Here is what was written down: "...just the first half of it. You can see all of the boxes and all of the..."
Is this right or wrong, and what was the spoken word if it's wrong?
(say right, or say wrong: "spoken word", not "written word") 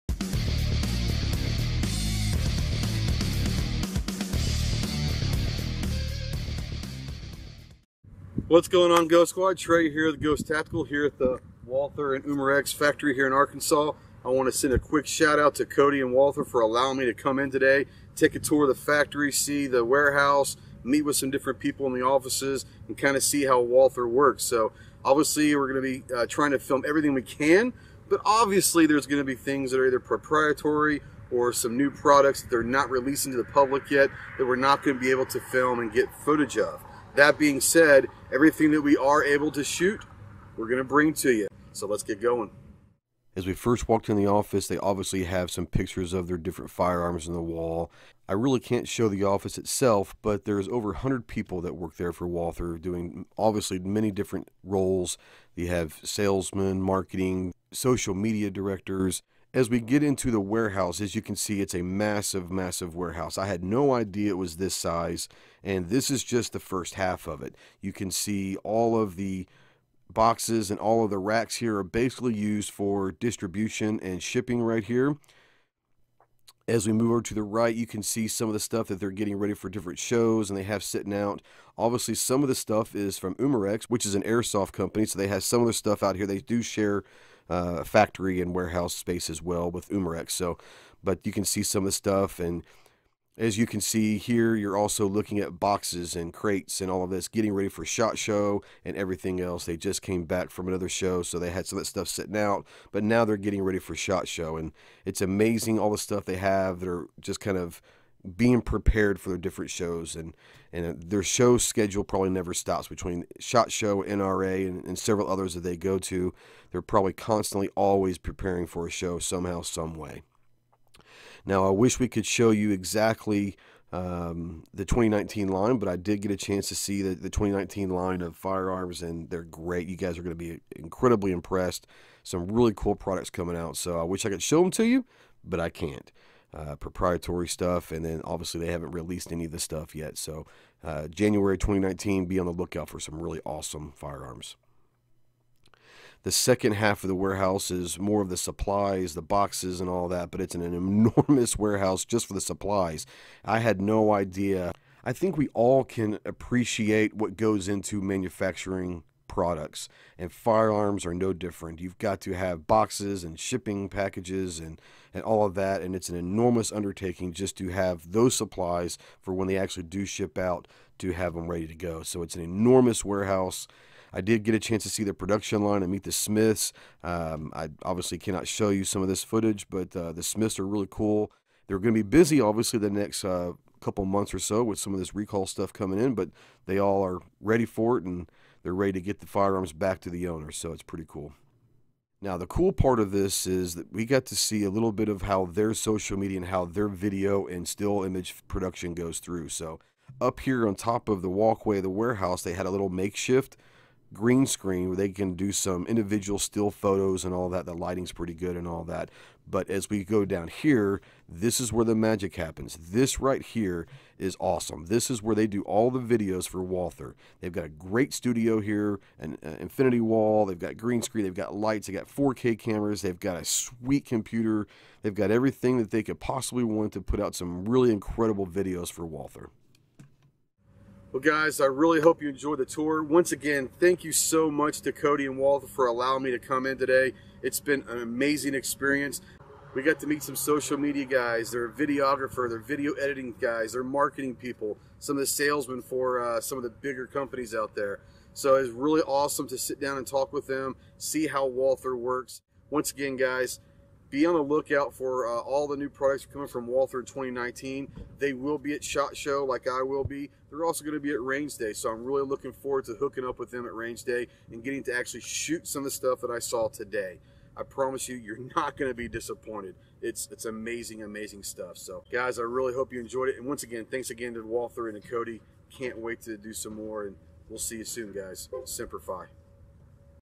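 right.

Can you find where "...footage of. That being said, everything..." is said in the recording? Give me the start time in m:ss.
0:36.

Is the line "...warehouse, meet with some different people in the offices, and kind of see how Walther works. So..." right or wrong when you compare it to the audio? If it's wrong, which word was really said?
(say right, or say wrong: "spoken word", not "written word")
right.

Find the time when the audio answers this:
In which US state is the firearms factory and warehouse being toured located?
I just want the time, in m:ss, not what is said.
0:13.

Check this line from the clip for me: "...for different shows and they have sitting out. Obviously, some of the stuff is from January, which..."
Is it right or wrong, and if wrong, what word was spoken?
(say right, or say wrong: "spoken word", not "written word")
wrong: "Umarex", not "January".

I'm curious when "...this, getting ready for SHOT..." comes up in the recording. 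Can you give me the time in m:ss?
1:37.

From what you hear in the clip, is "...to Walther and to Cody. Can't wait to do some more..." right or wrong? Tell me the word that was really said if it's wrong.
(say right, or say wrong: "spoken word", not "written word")
right.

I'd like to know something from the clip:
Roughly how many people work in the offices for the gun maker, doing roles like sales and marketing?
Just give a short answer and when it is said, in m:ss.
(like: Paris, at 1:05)
over 100, at 0:50.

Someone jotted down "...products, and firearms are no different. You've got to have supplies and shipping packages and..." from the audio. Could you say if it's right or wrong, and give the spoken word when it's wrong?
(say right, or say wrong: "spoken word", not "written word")
wrong: "boxes", not "supplies".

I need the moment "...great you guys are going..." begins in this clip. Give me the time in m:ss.
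2:09.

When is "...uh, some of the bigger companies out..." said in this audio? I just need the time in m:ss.
4:06.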